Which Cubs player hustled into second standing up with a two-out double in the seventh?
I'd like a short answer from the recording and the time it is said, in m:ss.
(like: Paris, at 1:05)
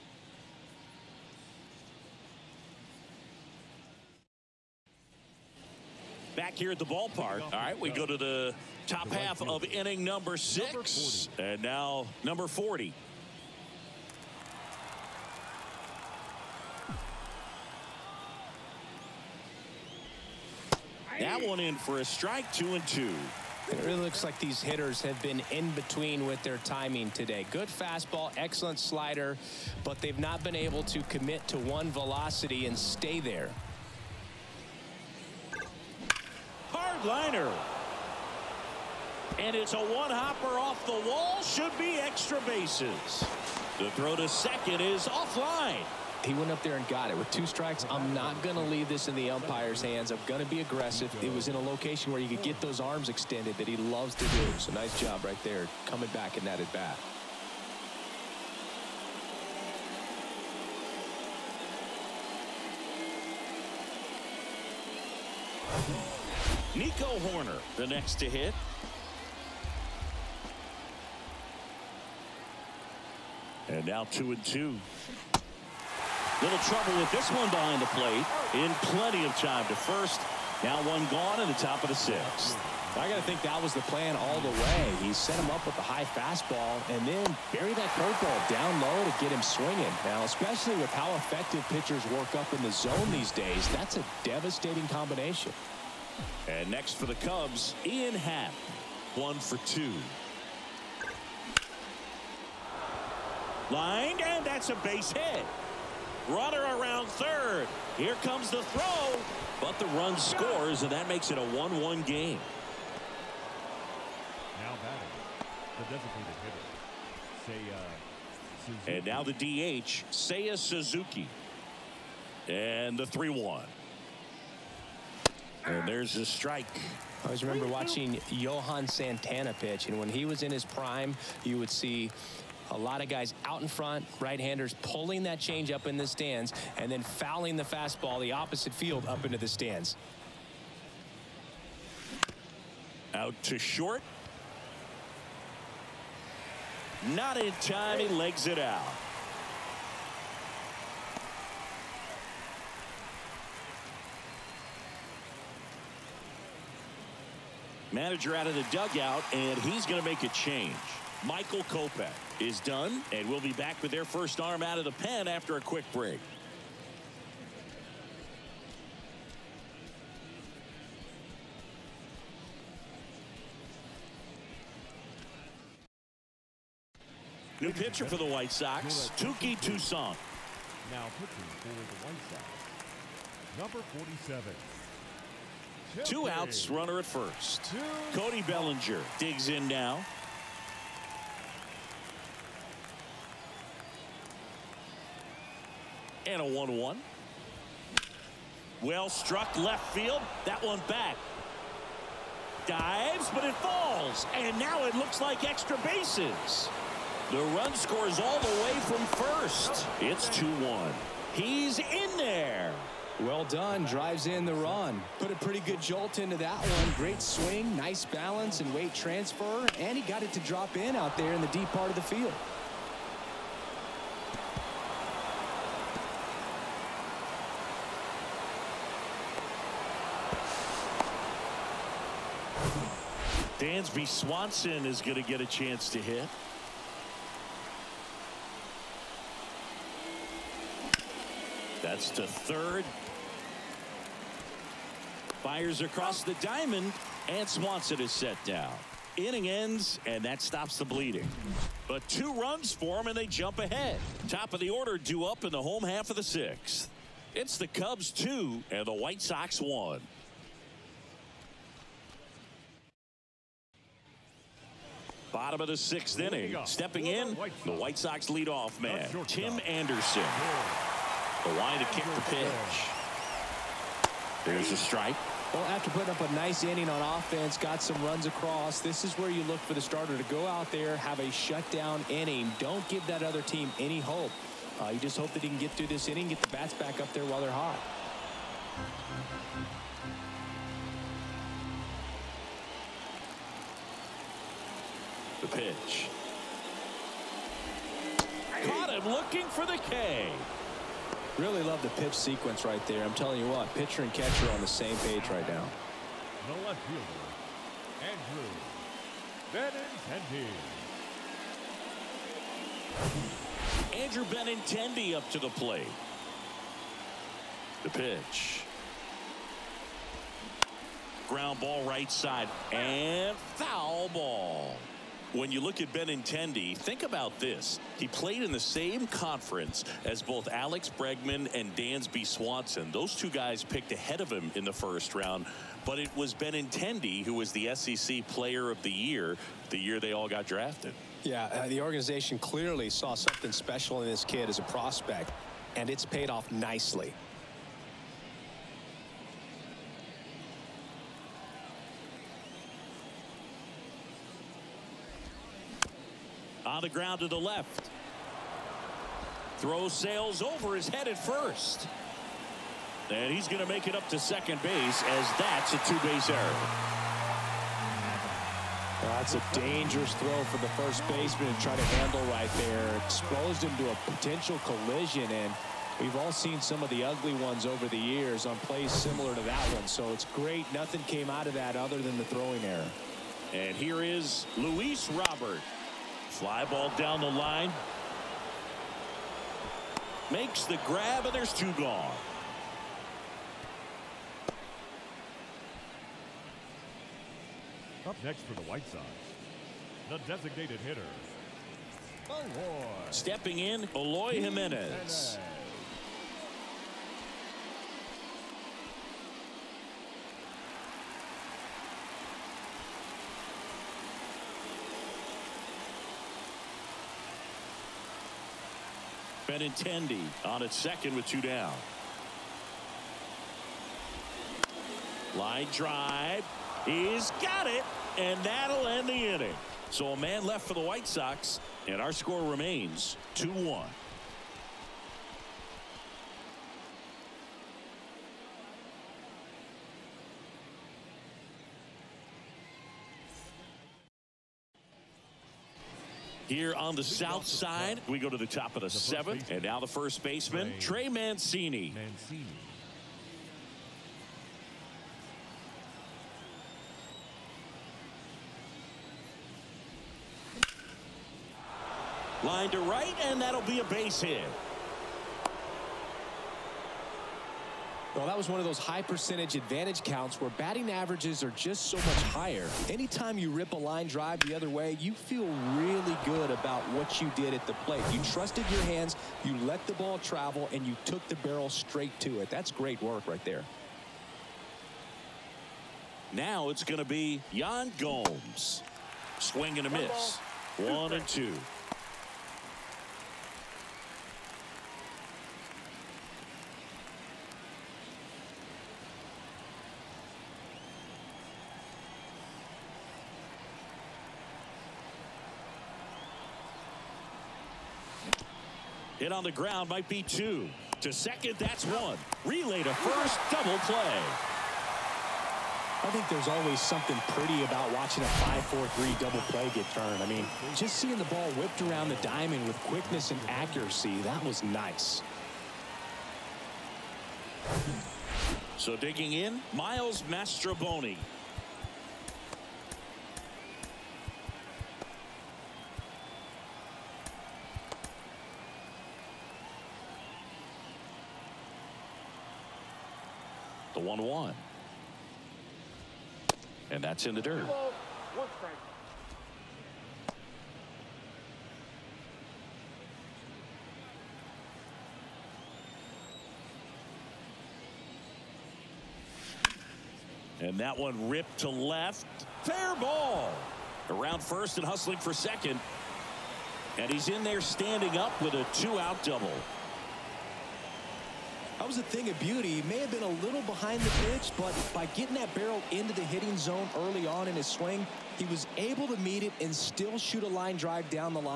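Miles Mastrobuoni, at 8:49.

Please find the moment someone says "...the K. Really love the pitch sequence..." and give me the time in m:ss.
4:59.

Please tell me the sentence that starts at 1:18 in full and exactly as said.
In plenty of time to first.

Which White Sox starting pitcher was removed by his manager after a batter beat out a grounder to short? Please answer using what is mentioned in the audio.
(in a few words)
Michael Kopech.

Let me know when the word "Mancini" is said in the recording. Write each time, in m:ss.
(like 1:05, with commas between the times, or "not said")
7:31.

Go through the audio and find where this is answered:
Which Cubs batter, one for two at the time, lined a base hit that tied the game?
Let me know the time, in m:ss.
1:37.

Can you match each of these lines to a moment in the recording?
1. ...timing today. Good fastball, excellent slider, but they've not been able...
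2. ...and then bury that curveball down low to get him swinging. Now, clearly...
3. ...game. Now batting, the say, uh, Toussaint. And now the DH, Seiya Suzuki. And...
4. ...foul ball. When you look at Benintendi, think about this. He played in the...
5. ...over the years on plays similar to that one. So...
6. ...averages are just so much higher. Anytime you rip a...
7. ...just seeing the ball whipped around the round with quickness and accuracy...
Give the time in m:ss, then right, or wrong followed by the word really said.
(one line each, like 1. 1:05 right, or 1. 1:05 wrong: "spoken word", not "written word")
1. 0:26 right
2. 1:26 wrong: "especially", not "clearly"
3. 1:52 wrong: "Suzuki", not "Toussaint"
4. 5:23 right
5. 6:17 right
6. 7:50 right
7. 8:40 wrong: "diamond", not "round".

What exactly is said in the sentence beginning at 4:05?
Fires across the diamond, and Swanson is set down.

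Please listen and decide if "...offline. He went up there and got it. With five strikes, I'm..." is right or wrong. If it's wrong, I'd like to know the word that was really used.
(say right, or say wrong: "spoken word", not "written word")
wrong: "two", not "five".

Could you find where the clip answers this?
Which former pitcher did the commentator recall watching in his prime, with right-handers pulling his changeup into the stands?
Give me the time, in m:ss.
2:08.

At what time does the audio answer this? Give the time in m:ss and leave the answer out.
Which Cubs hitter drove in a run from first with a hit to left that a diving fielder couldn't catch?
3:08.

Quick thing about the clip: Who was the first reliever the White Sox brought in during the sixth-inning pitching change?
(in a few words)
Touki Toussaint.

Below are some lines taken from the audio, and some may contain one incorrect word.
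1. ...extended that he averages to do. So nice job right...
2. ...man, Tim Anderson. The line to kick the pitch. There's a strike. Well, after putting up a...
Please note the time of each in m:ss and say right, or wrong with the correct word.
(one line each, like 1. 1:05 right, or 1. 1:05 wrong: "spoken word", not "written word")
1. 0:53 wrong: "loves", not "averages"
2. 4:28 right.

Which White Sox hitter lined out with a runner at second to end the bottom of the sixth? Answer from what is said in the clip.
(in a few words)
Eloy Jimenez.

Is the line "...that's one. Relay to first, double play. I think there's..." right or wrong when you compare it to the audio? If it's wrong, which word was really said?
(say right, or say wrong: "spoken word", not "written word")
right.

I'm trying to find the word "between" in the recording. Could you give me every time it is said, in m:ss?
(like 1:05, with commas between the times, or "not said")
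0:25.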